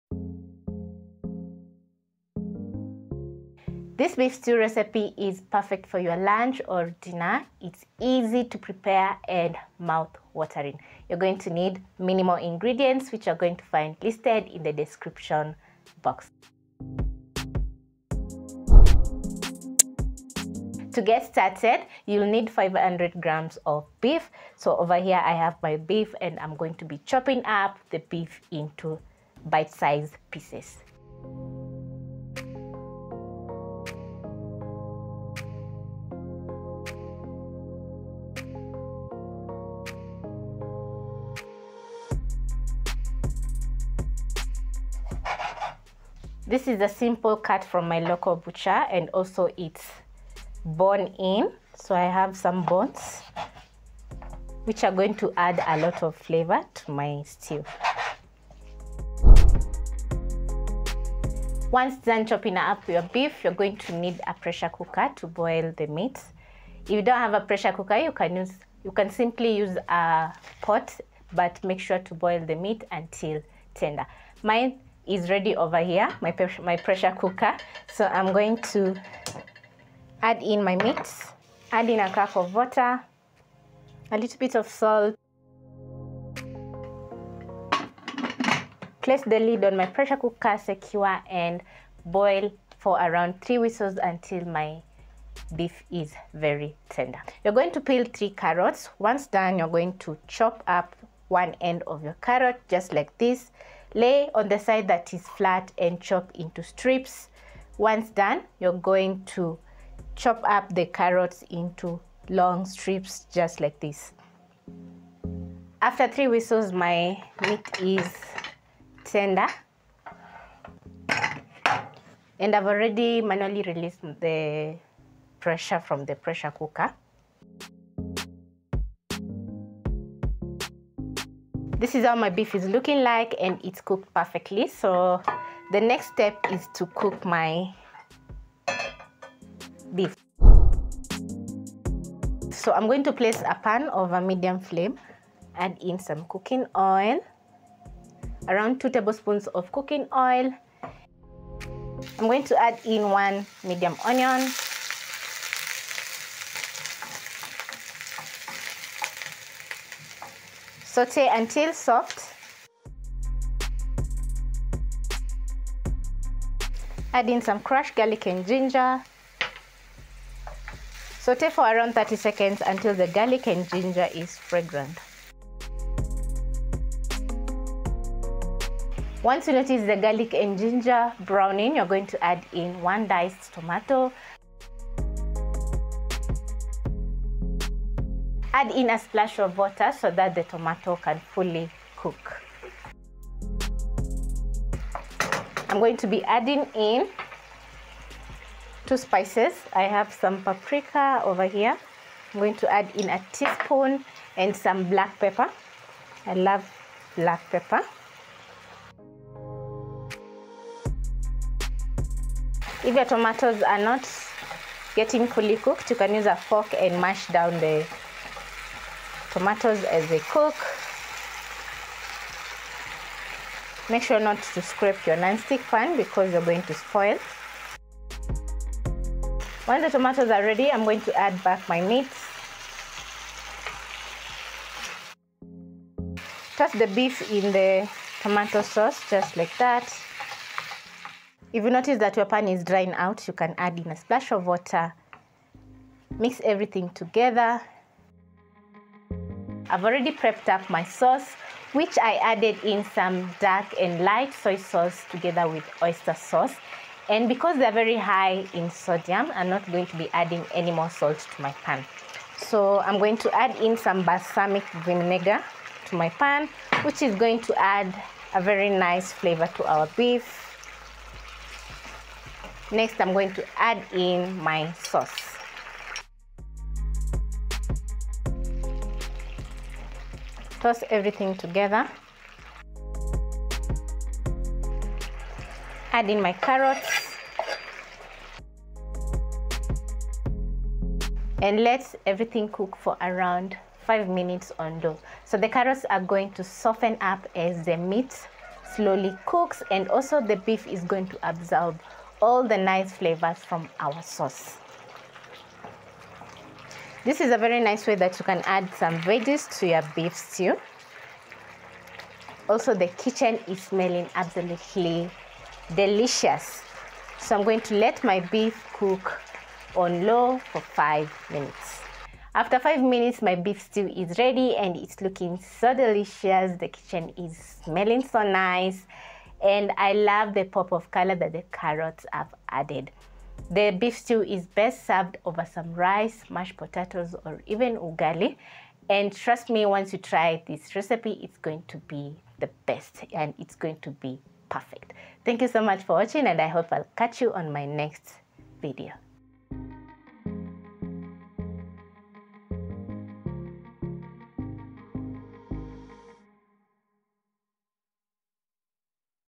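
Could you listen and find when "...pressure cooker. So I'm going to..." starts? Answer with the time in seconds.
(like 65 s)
76 s.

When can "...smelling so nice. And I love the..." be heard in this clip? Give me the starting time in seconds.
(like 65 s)
327 s.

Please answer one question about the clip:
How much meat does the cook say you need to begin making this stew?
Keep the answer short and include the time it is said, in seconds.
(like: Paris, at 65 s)
500 grams, at 22 s.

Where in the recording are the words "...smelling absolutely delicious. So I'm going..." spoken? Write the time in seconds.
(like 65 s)
313 s.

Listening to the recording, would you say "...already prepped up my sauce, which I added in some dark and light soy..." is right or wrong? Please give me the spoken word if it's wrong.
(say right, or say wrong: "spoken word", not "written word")
right.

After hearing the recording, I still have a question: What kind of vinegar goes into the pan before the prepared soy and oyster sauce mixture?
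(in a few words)
Balsamic vinegar.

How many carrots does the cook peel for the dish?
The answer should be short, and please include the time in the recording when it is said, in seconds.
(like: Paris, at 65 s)
3, at 98 s.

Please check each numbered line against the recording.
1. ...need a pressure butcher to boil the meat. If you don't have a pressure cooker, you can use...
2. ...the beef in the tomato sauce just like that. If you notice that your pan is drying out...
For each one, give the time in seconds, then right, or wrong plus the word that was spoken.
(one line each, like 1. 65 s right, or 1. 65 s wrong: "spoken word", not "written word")
1. 63 s wrong: "cooker", not "butcher"
2. 236 s right.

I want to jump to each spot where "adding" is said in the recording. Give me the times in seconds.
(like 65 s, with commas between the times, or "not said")
196 s, 260 s.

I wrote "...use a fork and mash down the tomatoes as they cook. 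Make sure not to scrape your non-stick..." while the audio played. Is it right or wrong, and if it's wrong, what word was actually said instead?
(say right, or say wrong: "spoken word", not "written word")
right.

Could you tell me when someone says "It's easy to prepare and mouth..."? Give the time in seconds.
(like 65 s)
7 s.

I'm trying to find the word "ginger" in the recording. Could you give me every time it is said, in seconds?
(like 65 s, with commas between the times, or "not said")
168 s, 173 s, 180 s.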